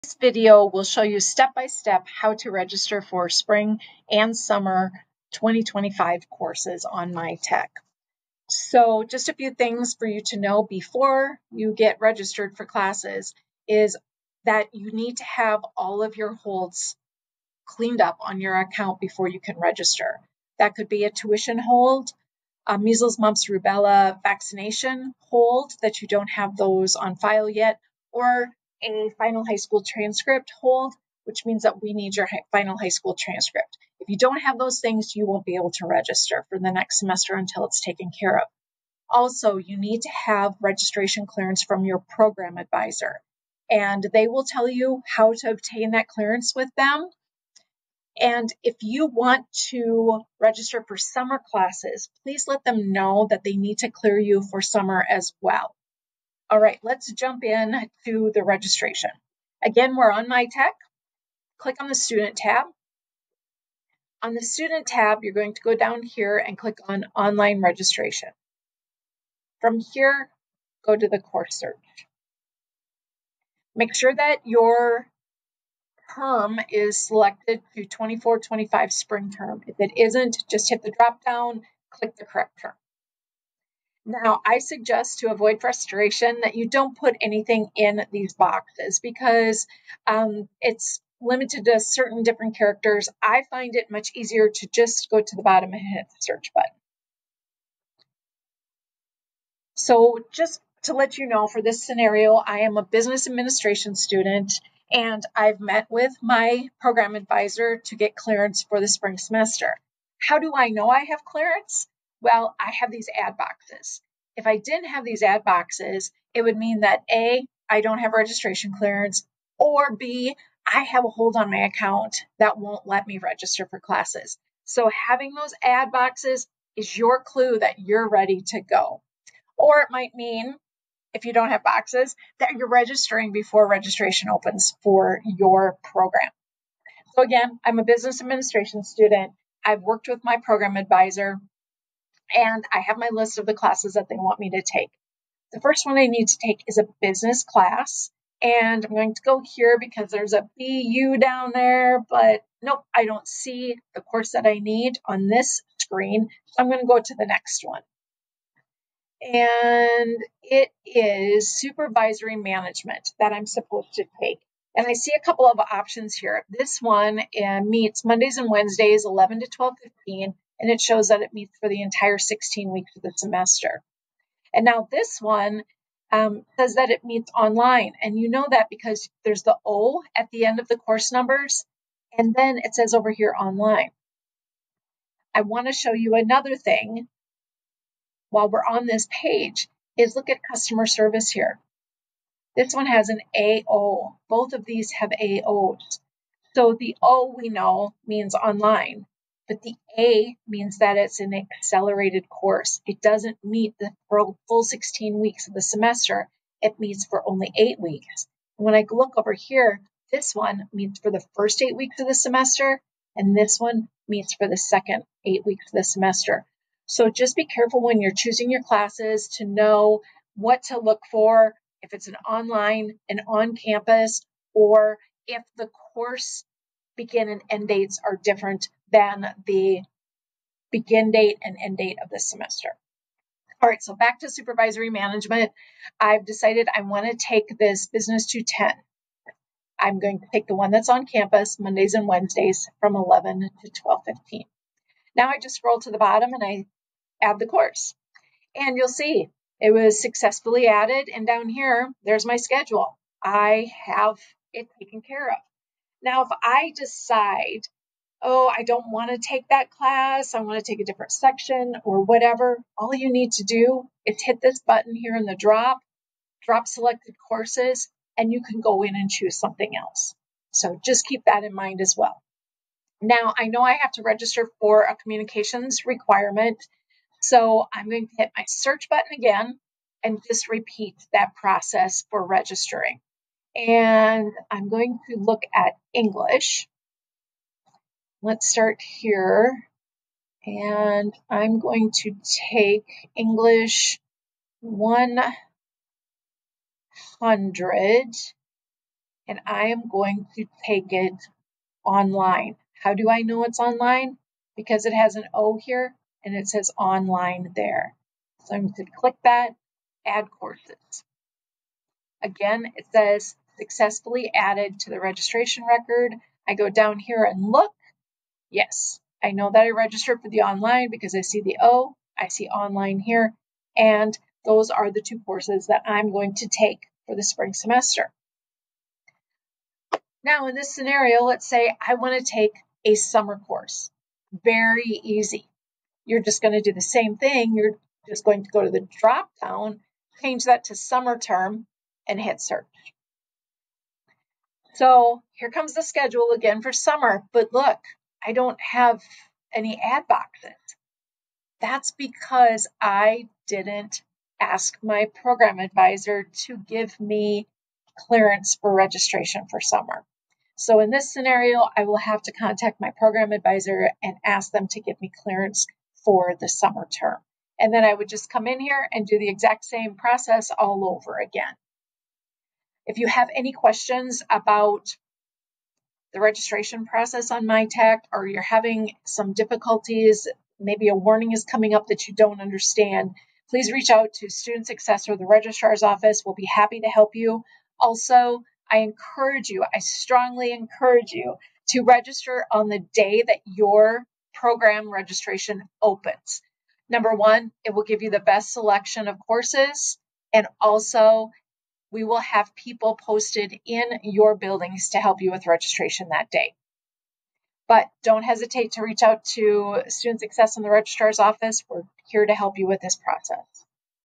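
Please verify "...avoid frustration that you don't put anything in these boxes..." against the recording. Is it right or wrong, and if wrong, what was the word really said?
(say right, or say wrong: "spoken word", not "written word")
right.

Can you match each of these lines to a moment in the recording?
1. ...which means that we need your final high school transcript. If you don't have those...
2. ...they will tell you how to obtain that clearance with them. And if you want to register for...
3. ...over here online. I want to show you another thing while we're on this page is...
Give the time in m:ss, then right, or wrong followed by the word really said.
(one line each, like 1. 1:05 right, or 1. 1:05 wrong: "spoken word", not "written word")
1. 0:31 right
2. 0:44 right
3. 3:02 right.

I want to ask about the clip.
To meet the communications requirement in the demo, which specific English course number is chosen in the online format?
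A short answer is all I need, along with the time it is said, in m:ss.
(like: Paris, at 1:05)
English 100, at 4:53.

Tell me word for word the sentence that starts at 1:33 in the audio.
I find it much easier to just go to the bottom and hit the search button.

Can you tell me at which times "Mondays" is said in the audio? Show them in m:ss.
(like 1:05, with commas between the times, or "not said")
2:48, 4:01.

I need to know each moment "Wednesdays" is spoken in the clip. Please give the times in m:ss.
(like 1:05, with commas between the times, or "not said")
2:48, 4:02.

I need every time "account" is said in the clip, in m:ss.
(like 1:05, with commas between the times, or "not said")
0:18, 2:01.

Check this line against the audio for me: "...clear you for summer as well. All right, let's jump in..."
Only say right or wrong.
right.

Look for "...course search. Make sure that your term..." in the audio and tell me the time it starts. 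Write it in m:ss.
1:11.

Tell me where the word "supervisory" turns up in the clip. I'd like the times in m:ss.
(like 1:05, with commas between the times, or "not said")
2:41, 3:54.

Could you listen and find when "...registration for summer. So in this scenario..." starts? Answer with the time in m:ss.
5:58.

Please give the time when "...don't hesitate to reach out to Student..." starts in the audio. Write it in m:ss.
6:48.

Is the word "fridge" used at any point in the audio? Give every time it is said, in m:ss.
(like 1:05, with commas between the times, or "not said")
not said.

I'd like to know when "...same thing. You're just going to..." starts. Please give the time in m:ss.
5:36.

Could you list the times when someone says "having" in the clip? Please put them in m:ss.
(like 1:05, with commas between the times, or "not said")
2:04, 6:18.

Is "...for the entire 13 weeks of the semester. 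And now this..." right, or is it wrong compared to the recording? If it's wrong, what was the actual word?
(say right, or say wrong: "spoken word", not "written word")
wrong: "16", not "13".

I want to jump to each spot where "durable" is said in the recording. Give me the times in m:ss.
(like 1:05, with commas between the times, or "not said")
not said.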